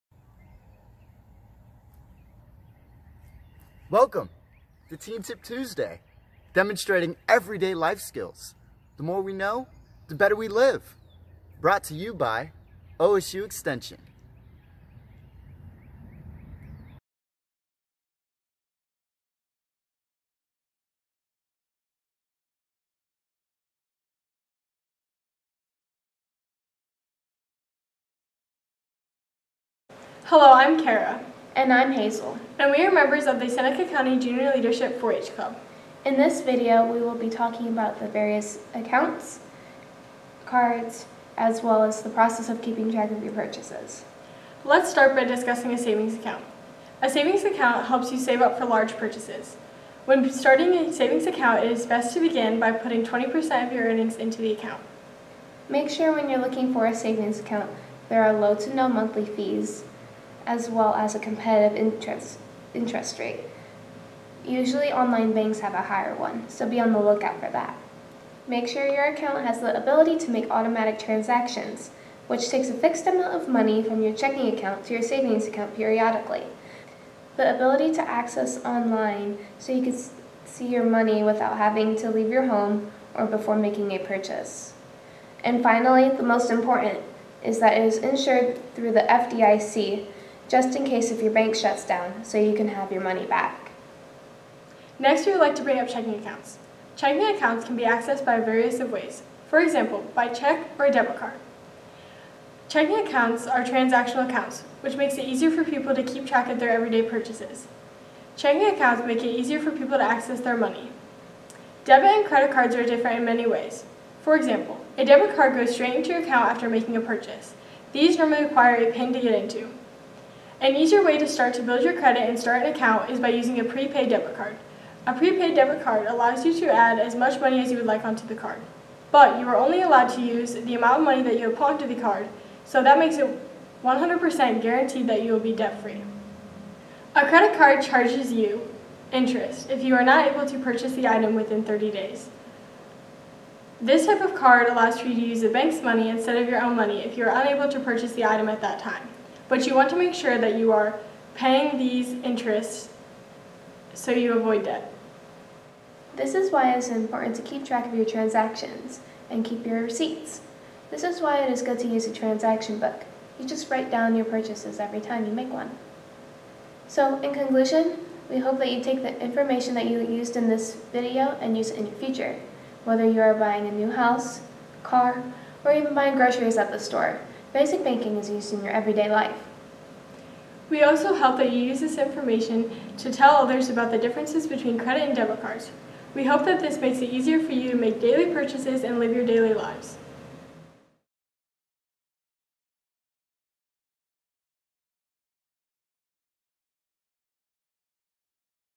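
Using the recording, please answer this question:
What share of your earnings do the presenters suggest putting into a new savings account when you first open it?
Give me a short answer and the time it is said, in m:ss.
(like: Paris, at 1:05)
20%, at 0:53.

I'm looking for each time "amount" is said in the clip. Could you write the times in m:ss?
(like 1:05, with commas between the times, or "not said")
1:13, 2:10.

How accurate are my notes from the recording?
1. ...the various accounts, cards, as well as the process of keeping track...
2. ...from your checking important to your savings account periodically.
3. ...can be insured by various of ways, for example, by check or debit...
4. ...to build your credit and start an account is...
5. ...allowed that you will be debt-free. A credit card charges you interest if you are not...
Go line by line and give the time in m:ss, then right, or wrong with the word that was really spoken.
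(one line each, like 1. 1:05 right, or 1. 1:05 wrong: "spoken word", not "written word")
1. 0:37 right
2. 1:13 wrong: "account", not "important"
3. 1:37 wrong: "accessed", not "insured"
4. 2:01 right
5. 2:14 wrong: "guaranteed", not "allowed".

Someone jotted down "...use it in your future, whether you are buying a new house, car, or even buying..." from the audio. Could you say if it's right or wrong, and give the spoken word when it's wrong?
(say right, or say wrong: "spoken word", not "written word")
right.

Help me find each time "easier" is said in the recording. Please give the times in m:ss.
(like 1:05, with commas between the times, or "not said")
1:45, 1:49, 2:00, 3:07.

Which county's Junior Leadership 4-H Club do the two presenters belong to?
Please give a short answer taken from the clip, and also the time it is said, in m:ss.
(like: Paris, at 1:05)
Seneca County, at 0:33.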